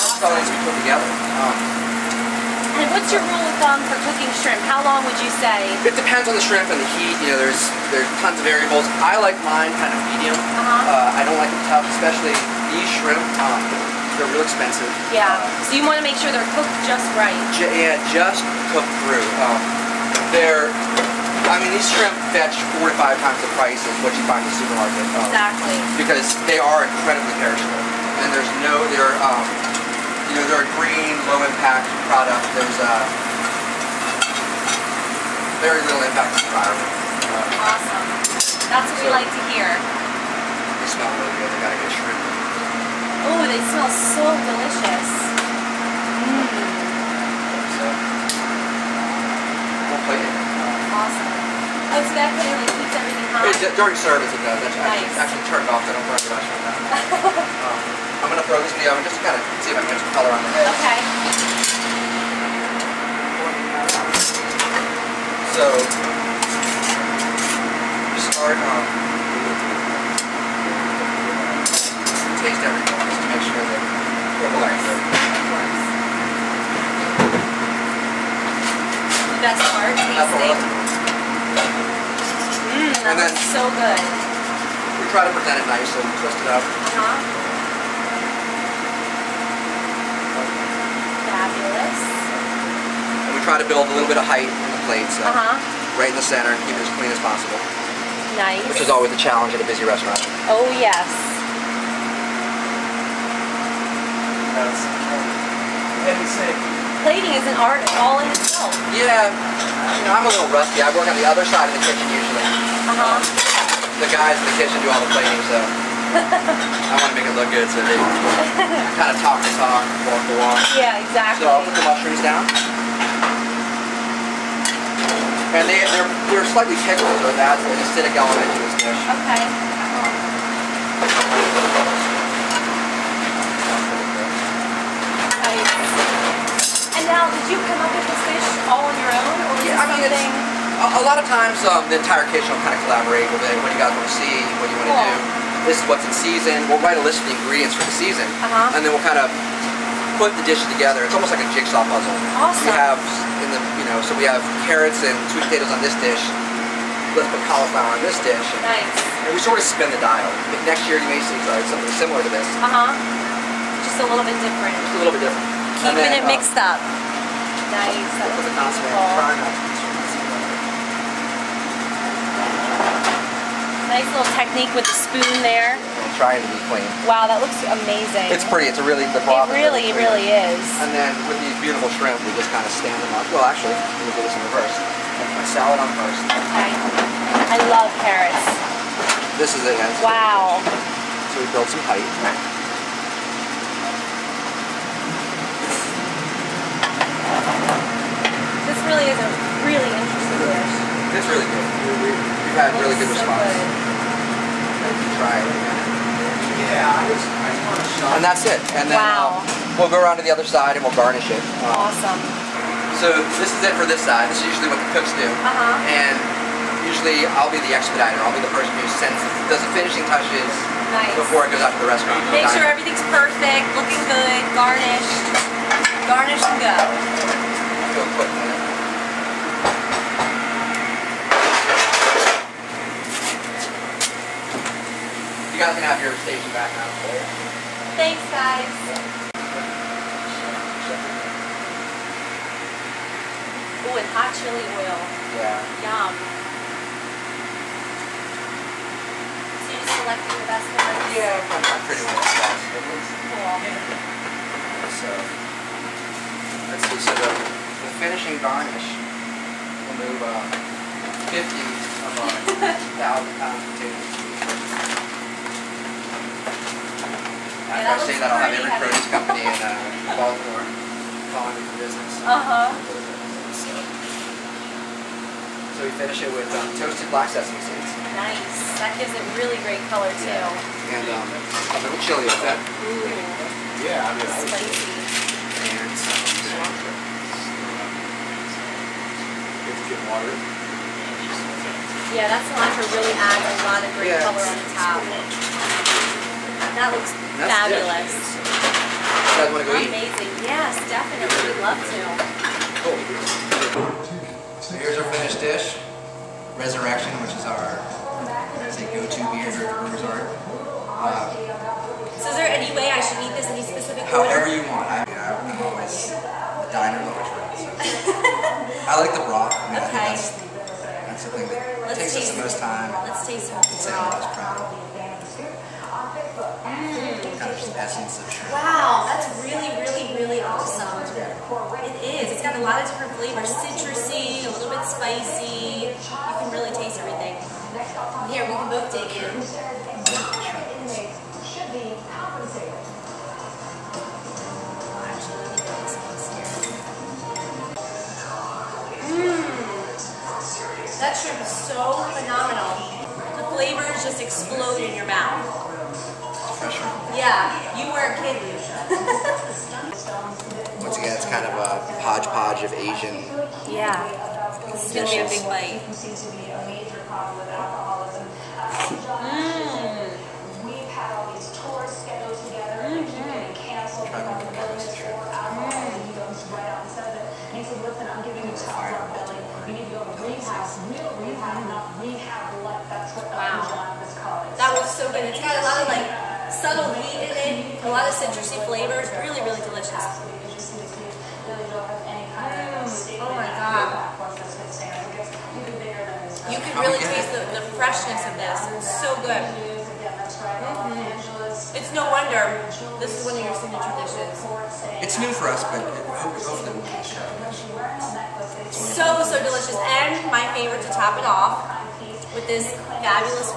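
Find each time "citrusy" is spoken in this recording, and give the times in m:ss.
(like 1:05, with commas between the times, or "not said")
5:33, 6:28.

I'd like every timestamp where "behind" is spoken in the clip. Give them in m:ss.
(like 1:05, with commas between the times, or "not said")
not said.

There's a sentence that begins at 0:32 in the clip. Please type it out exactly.
There's uh, very little impact on the environment.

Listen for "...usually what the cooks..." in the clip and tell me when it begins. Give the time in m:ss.
3:34.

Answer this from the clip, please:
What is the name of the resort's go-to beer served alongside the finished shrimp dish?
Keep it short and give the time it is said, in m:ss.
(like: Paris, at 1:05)
Resurrection, at 5:06.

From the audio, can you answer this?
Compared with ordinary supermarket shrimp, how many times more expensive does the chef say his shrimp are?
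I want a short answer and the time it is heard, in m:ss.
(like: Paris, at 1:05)
4 to 5 times, at 0:22.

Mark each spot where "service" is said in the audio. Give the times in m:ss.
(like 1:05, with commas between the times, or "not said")
0:53.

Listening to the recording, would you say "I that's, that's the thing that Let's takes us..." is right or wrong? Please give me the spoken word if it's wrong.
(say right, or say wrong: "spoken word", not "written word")
right.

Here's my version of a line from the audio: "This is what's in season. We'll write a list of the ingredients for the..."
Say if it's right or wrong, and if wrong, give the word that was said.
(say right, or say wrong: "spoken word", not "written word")
right.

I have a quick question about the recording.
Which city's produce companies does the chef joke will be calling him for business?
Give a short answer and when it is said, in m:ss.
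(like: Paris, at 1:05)
Baltimore, at 4:30.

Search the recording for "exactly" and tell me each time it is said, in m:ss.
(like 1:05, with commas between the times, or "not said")
0:25, 2:01.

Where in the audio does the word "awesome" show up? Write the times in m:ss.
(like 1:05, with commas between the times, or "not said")
0:37, 0:50, 2:32, 3:31, 5:30.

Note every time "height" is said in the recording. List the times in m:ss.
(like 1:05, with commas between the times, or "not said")
1:34, 3:11.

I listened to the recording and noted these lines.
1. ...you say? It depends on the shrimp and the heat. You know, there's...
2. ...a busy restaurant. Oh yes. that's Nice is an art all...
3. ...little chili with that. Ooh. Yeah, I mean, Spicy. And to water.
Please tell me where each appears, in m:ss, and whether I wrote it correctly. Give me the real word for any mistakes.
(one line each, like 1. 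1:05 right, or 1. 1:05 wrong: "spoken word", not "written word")
1. 0:05 right
2. 1:39 wrong: "Plating", not "Nice"
3. 4:41 right.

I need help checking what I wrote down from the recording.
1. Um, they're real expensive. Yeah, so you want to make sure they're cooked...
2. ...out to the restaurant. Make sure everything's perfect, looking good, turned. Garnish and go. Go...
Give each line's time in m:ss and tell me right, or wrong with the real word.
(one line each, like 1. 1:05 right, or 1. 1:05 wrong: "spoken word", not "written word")
1. 0:13 right
2. 3:41 wrong: "garnished", not "turned".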